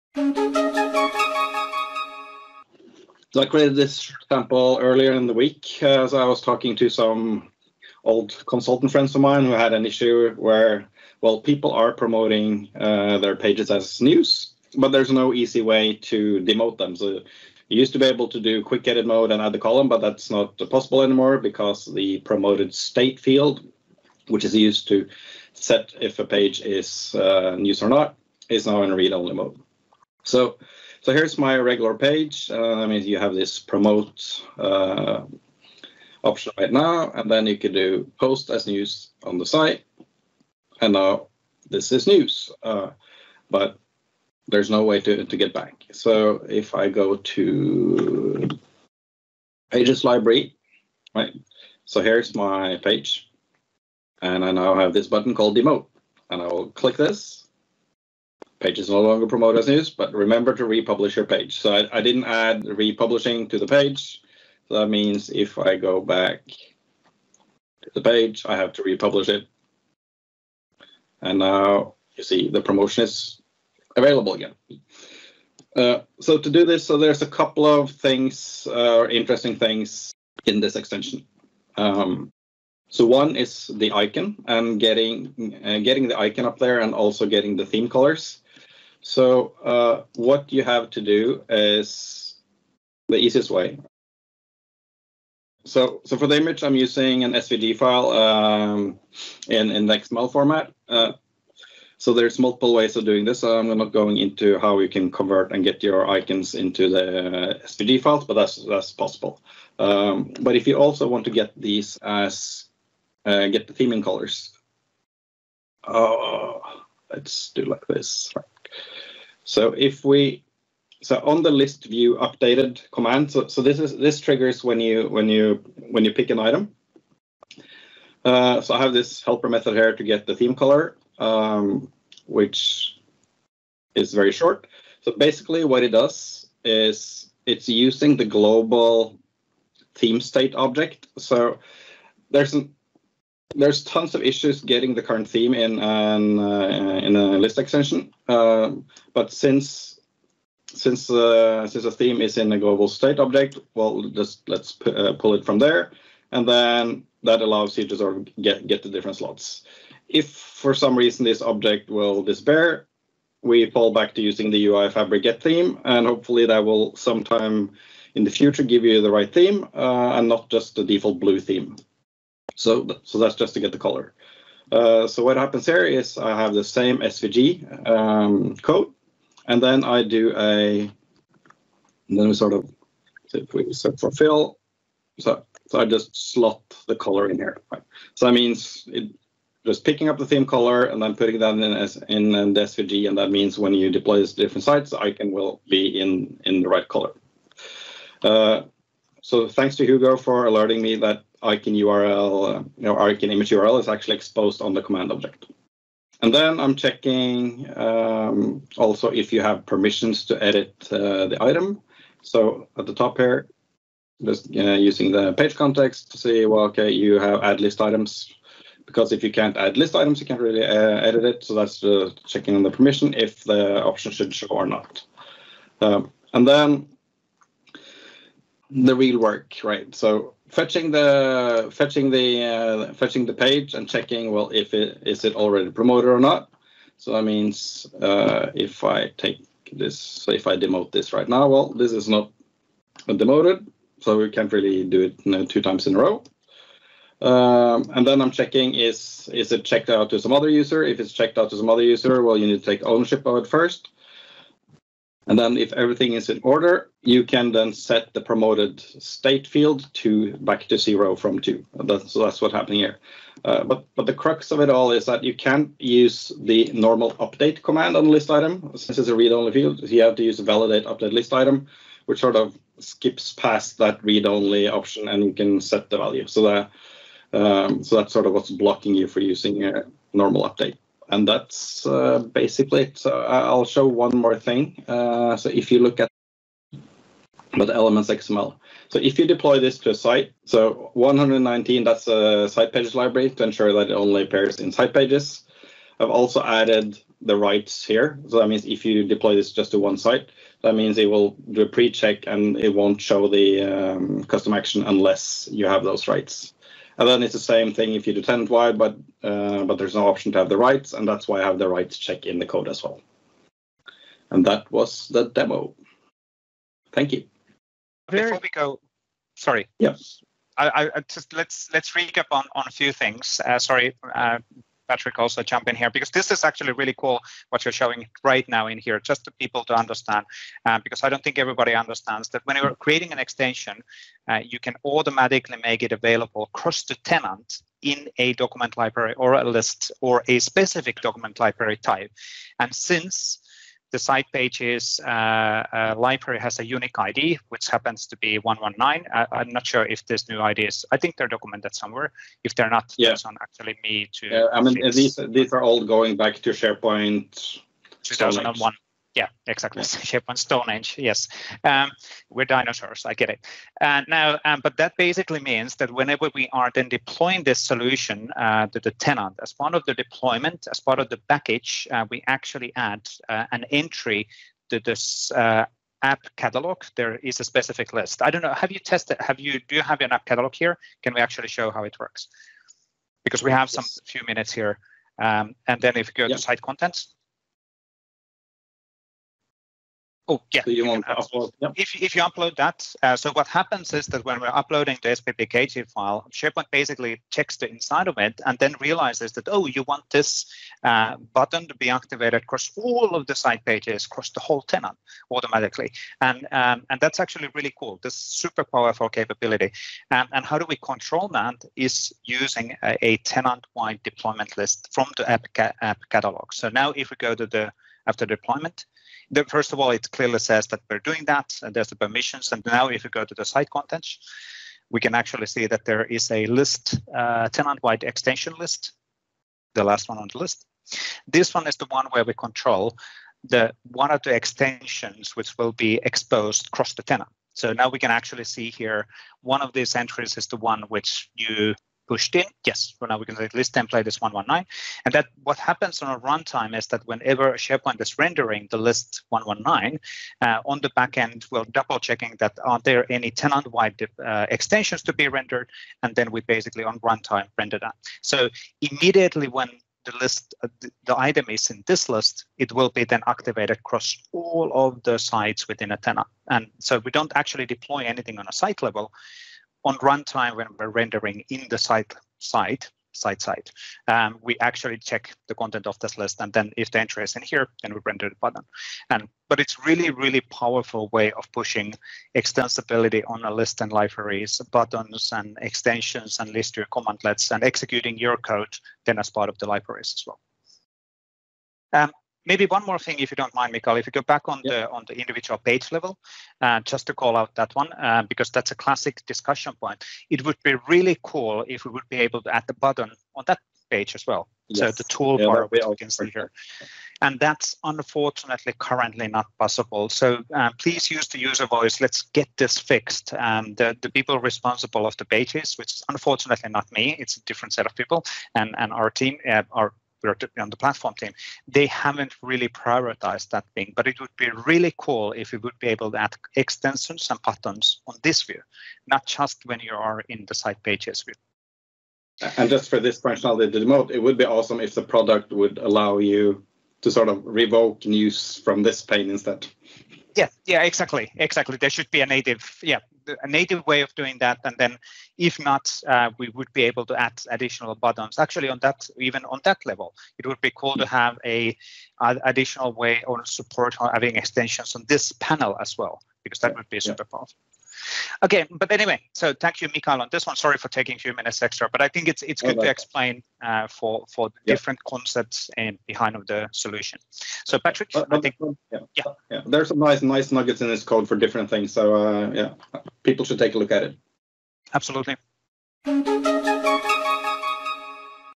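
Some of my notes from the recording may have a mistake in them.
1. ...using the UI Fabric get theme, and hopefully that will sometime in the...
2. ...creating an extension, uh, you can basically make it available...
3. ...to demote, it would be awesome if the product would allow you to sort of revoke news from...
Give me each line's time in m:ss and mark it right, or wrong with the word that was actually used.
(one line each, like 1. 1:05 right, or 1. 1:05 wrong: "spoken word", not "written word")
1. 2:44 right
2. 5:32 wrong: "automatically", not "basically"
3. 8:53 right.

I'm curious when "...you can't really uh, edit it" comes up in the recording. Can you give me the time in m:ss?
3:40.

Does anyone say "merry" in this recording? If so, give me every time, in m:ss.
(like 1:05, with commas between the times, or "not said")
not said.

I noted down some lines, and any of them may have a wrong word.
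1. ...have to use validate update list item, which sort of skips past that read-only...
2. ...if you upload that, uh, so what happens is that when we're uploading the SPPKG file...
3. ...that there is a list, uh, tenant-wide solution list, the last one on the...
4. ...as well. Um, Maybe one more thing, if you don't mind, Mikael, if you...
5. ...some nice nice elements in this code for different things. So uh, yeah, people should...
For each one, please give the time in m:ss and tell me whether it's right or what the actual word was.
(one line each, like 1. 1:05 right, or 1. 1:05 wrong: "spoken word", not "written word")
1. 4:30 right
2. 6:32 right
3. 7:05 wrong: "extension", not "solution"
4. 8:10 right
5. 9:29 wrong: "nuggets", not "elements".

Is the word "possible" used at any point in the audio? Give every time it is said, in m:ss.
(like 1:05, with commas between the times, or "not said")
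0:20, 1:48, 8:29.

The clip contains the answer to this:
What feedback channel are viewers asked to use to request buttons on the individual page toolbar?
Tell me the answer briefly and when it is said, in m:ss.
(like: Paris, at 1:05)
UserVoice, at 8:31.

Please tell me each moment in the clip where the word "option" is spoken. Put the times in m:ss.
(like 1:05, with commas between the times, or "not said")
0:36, 3:43, 4:34, 5:10.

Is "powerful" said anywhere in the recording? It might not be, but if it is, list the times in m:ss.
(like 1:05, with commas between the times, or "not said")
6:48, 8:00, 9:17.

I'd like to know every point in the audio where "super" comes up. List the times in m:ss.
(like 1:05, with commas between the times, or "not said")
6:48, 9:16.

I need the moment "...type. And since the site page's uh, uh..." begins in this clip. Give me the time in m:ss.
5:41.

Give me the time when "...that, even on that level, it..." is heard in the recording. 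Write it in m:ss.
9:08.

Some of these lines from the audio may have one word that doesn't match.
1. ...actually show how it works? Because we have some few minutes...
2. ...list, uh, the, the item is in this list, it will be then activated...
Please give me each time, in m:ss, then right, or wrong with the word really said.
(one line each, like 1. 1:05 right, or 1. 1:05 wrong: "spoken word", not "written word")
1. 6:21 right
2. 7:40 right.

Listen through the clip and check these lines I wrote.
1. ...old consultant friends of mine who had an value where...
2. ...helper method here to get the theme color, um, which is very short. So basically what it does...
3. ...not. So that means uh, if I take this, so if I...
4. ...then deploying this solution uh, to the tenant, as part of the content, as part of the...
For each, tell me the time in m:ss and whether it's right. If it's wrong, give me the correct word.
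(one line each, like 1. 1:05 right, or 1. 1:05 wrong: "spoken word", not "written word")
1. 0:08 wrong: "issue", not "value"
2. 2:09 right
3. 3:56 right
4. 6:06 wrong: "deployment", not "content".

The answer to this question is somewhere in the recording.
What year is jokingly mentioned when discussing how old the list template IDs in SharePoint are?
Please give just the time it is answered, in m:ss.
5:58.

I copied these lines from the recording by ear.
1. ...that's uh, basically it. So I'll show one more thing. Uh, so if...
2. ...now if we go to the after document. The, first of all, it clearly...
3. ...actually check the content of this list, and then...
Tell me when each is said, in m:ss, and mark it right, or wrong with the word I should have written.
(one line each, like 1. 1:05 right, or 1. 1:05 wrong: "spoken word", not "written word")
1. 4:41 right
2. 6:56 wrong: "deployment", not "document"
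3. 7:54 right.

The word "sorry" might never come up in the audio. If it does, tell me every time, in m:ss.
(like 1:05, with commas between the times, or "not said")
5:19, 5:23, 9:20.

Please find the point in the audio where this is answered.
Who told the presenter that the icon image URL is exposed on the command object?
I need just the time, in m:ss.
3:19.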